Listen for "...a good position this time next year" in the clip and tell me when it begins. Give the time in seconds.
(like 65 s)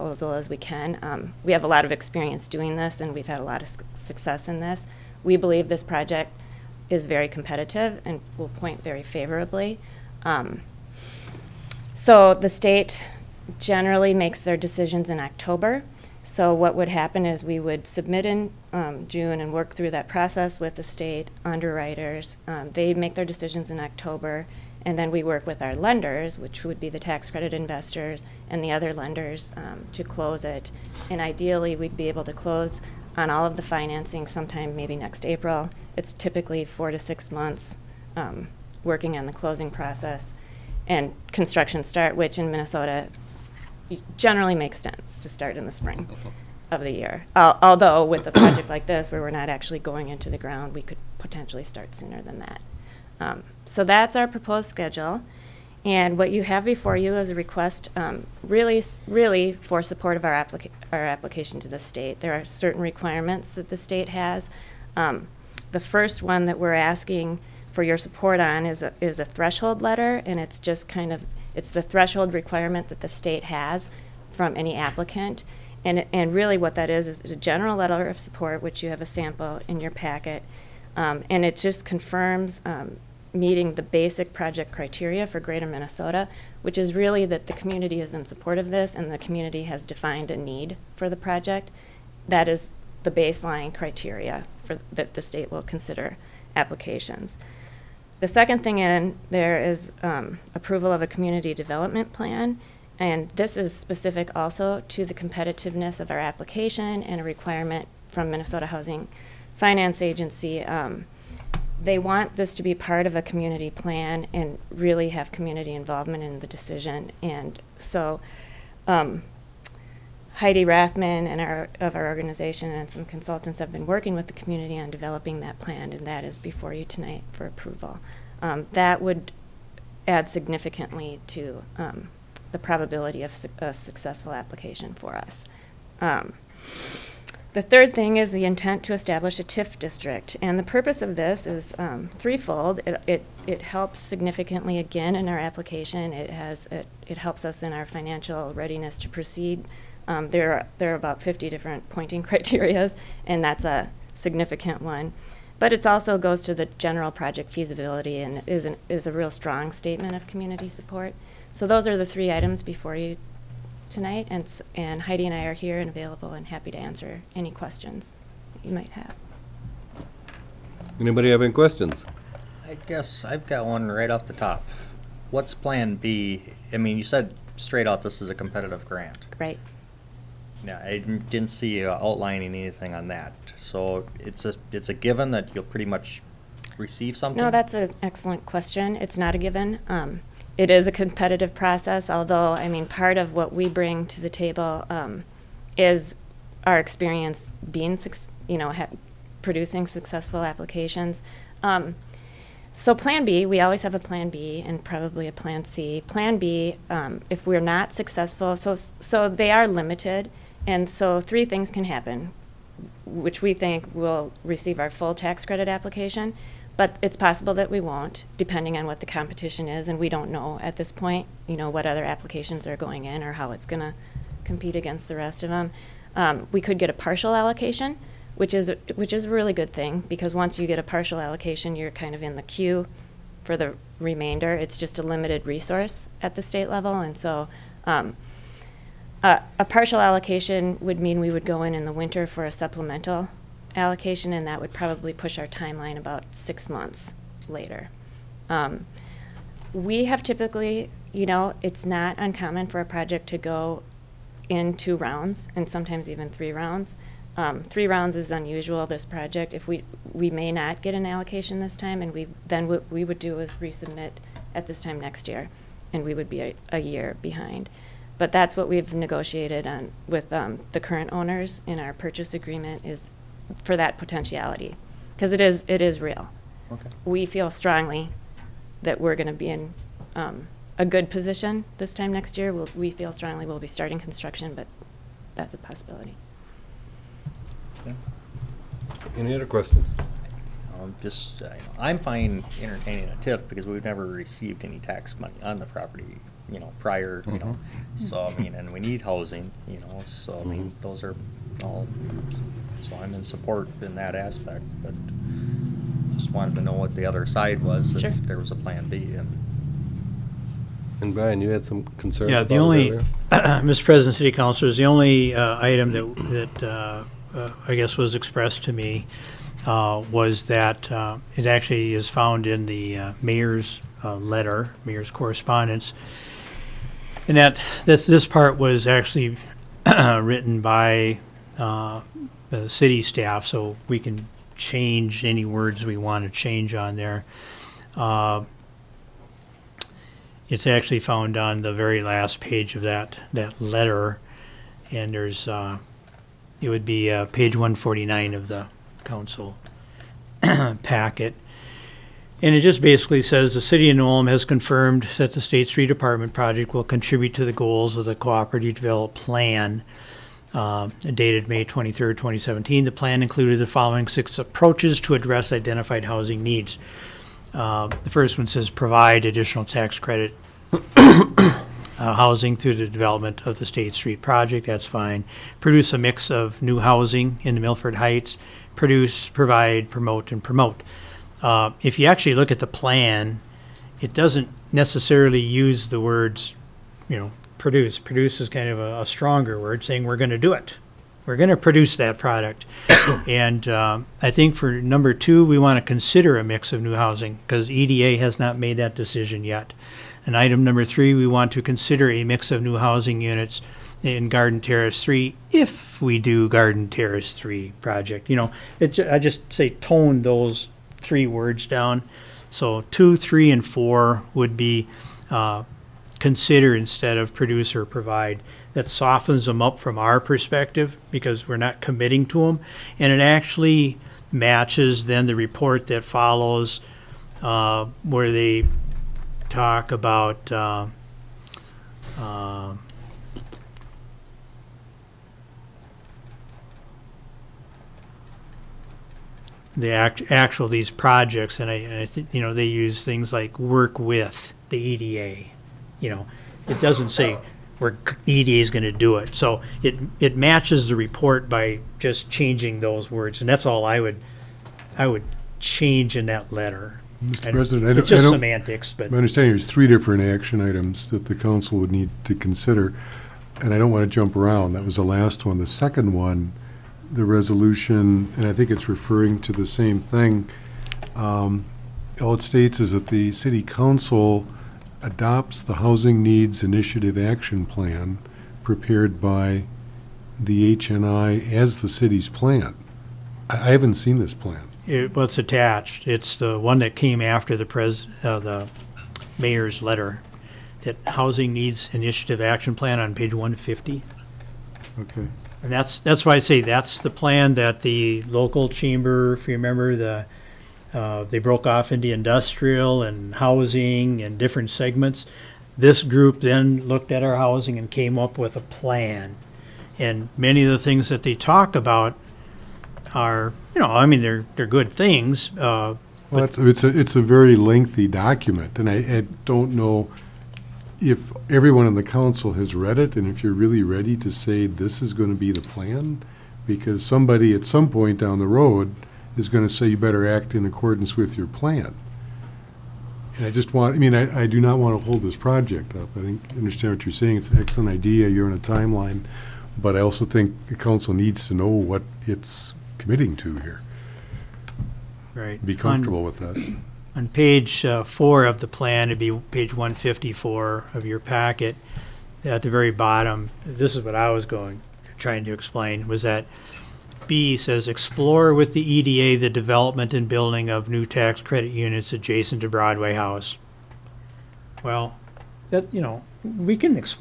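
280 s.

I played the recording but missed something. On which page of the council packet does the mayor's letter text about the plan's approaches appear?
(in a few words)
149.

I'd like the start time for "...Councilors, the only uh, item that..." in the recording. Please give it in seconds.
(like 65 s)
314 s.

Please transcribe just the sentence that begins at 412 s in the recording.
So two, three, and four would be uh, consider instead of produce or provide.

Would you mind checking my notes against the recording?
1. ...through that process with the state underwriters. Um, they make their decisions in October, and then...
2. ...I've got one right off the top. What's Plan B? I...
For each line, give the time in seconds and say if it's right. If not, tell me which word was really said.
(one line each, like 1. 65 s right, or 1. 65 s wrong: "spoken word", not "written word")
1. 19 s right
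2. 173 s right.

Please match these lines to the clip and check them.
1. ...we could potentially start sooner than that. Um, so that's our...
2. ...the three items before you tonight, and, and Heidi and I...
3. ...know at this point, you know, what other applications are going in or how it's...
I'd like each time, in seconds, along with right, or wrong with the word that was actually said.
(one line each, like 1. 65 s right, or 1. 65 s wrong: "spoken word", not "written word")
1. 50 s right
2. 161 s right
3. 220 s right.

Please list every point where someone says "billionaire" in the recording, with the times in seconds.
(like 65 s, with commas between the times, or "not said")
not said.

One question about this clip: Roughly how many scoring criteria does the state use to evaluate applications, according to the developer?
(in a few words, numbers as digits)
50.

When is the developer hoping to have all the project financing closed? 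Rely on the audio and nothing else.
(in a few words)
next April.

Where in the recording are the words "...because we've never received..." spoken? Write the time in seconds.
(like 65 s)
293 s.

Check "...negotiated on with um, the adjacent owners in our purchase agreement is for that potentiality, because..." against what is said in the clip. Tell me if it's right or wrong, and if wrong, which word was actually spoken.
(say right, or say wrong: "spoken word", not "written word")
wrong: "current", not "adjacent".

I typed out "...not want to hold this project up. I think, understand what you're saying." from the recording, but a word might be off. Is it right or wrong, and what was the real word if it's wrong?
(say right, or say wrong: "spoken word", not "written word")
right.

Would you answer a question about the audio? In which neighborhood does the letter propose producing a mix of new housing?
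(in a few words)
Milford Heights.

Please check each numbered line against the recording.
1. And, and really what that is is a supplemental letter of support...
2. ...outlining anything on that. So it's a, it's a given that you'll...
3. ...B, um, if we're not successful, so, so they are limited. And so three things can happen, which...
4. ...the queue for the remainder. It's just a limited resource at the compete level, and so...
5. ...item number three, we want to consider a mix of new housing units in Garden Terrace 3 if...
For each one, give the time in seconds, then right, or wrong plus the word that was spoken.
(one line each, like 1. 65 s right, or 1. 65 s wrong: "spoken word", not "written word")
1. 75 s wrong: "general", not "supplemental"
2. 181 s right
3. 206 s right
4. 232 s wrong: "state", not "compete"
5. 400 s right.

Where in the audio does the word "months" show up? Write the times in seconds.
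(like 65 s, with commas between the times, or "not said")
37 s, 246 s.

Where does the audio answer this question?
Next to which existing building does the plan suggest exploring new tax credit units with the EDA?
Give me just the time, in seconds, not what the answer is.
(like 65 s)
562 s.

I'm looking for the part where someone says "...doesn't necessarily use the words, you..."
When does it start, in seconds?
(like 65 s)
384 s.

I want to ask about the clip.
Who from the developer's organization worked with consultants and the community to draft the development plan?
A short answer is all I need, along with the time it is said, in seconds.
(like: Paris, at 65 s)
Heidi Rathman, at 120 s.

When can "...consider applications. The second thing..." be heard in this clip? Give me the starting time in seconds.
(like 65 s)
95 s.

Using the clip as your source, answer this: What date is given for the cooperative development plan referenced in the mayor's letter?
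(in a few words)
May 23, 2017.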